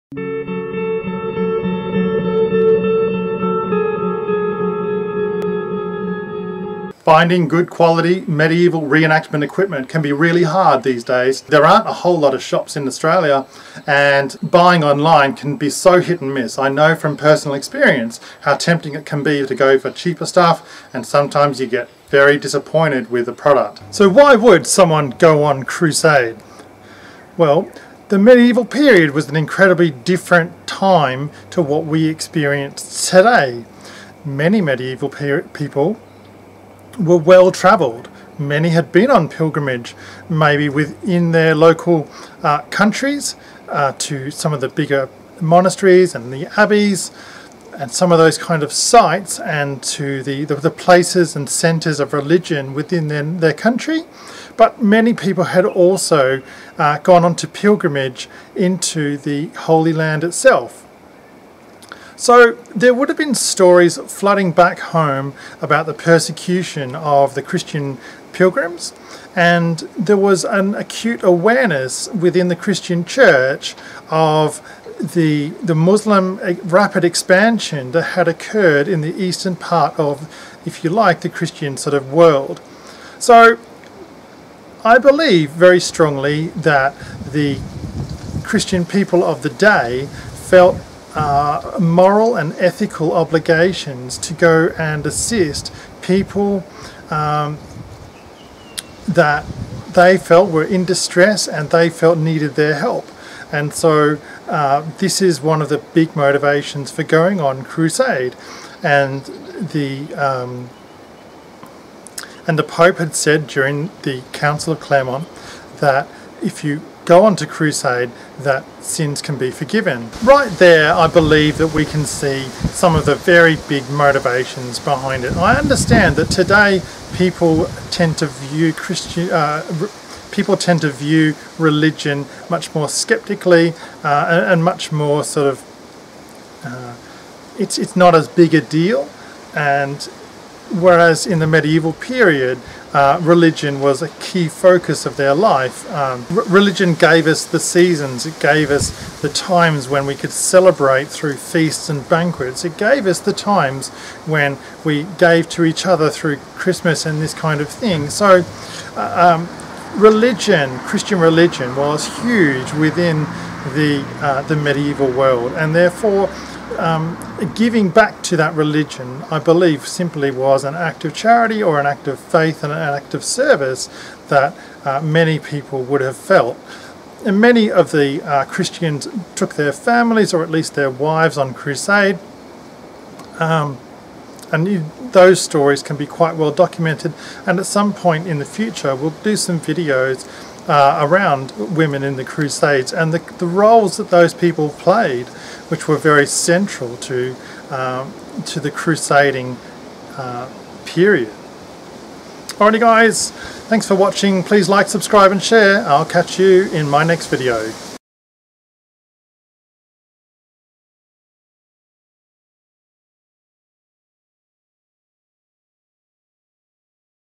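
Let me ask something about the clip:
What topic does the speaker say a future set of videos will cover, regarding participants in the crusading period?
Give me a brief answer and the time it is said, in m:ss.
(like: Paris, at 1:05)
Women in the Crusades, at 3:11.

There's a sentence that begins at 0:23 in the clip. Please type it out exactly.
So why would someone go on crusade?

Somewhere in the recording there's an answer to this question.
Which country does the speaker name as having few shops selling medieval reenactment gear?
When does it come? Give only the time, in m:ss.
0:12.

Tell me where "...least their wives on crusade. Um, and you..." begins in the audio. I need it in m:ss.
3:00.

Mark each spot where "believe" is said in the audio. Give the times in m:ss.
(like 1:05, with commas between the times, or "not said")
1:24, 2:01, 2:49.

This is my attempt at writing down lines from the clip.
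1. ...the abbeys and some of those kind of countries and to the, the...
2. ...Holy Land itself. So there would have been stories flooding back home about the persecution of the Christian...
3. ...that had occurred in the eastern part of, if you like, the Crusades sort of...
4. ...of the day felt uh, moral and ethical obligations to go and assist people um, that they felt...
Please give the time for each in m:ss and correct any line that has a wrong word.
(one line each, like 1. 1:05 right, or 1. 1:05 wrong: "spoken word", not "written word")
1. 0:46 wrong: "sites", not "countries"
2. 0:59 right
3. 1:17 wrong: "Christian", not "Crusades"
4. 1:29 right.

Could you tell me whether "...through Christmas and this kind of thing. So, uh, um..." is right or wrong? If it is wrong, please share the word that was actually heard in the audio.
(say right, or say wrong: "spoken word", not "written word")
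right.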